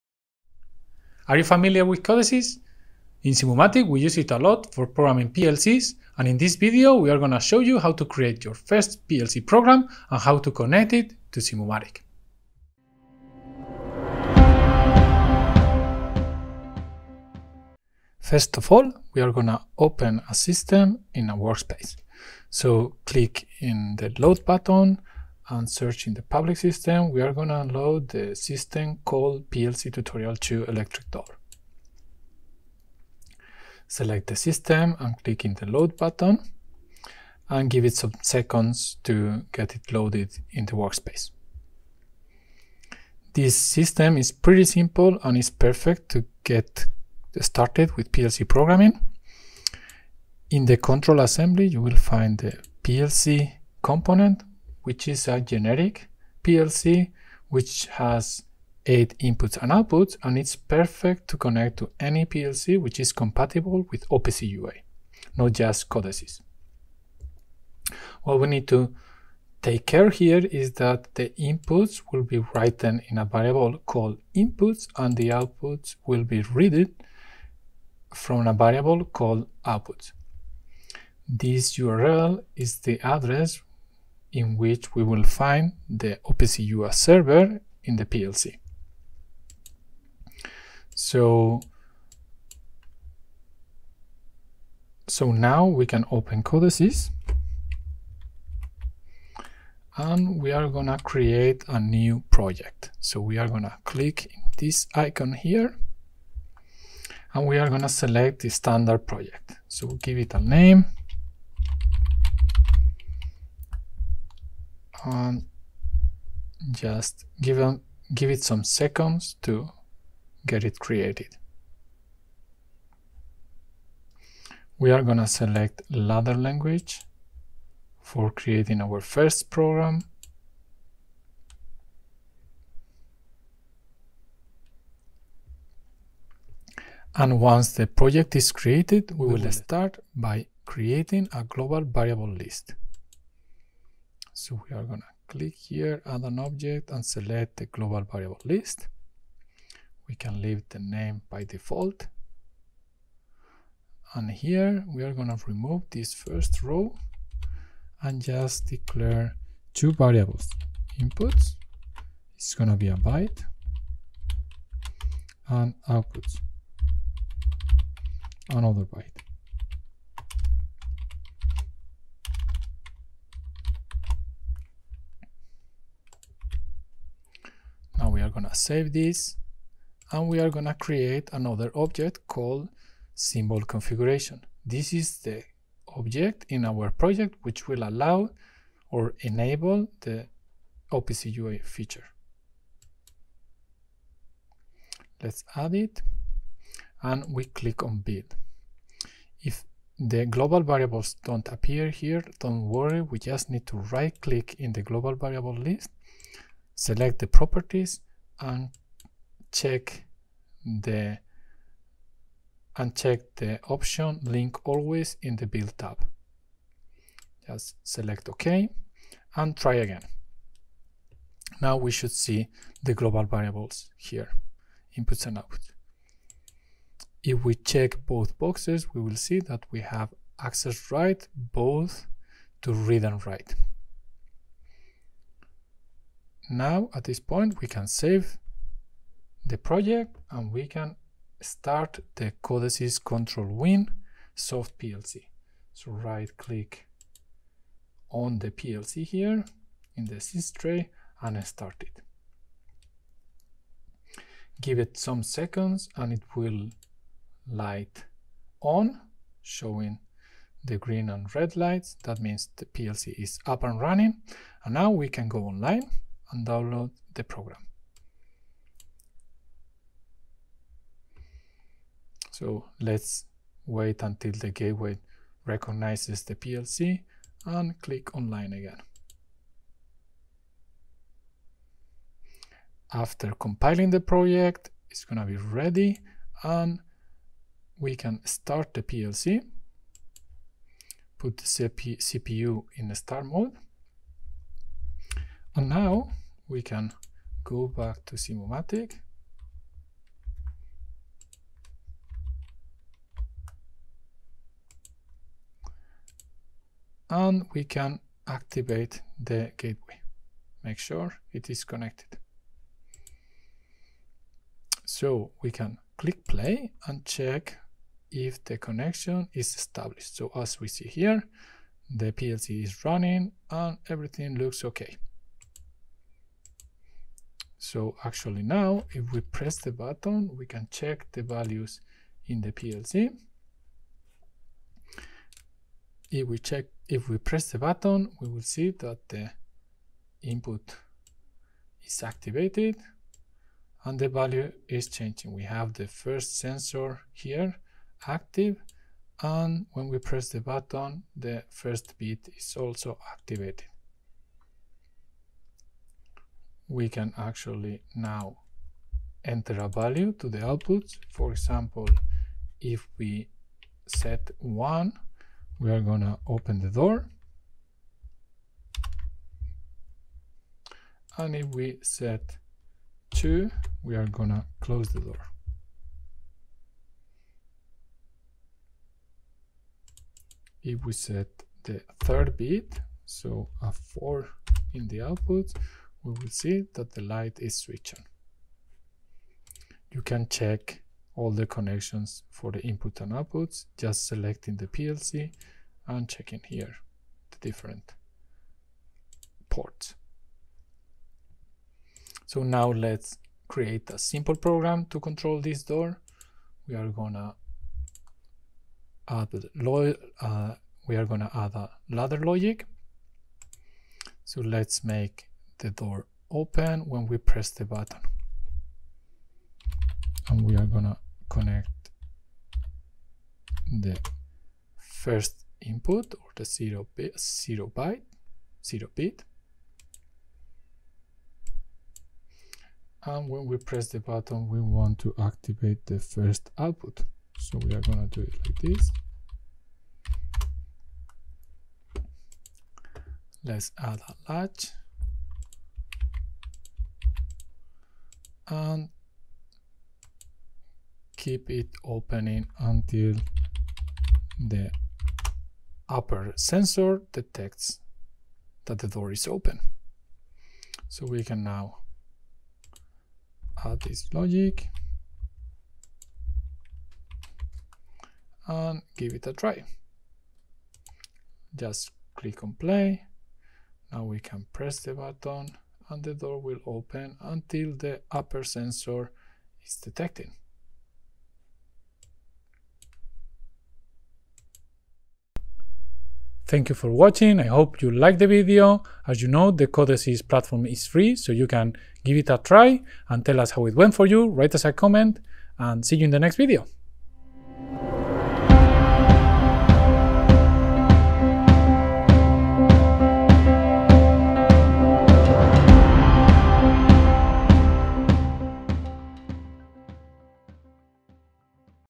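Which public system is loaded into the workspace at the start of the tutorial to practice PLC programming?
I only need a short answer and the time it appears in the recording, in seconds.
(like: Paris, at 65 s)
PLC Tutorial 2 Electric Door, at 29 s.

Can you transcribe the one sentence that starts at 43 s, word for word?
This system is pretty simple and is perfect to get started with PLC programming.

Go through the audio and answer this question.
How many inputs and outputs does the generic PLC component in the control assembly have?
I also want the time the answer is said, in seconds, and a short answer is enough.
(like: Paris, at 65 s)
8, at 58 s.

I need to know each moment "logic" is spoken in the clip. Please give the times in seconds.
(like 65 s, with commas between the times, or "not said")
412 s, 464 s.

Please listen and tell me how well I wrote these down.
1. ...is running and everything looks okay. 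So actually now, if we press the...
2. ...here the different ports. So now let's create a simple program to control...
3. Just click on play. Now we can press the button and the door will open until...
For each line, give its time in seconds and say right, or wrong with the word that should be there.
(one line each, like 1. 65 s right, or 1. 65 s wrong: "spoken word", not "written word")
1. 322 s right
2. 396 s right
3. 471 s right.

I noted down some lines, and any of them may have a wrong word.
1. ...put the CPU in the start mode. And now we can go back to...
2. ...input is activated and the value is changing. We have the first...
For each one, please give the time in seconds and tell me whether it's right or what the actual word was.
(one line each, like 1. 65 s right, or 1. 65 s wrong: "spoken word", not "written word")
1. 291 s right
2. 340 s right.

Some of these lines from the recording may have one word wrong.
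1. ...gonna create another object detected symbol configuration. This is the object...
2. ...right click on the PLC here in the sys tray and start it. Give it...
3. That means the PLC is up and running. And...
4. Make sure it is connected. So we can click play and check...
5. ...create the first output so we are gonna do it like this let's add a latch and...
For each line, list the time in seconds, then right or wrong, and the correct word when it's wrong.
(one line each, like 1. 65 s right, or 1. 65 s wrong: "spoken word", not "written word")
1. 180 s wrong: "called", not "detected"
2. 245 s right
3. 262 s right
4. 310 s right
5. 435 s wrong: "activate", not "create".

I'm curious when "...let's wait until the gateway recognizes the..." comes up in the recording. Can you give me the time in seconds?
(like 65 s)
272 s.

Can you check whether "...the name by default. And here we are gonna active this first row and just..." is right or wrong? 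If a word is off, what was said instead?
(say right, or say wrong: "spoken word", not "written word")
wrong: "remove", not "active".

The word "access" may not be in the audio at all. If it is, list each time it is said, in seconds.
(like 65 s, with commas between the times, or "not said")
230 s.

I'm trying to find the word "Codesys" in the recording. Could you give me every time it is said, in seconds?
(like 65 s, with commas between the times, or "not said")
2 s, 65 s, 96 s, 242 s, 489 s.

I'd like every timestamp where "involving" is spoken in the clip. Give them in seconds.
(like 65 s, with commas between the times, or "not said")
not said.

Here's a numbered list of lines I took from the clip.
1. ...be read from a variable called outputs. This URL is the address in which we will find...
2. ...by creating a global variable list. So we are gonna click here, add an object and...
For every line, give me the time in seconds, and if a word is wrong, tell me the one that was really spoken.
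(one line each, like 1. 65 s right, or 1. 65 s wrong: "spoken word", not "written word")
1. 76 s right
2. 140 s right.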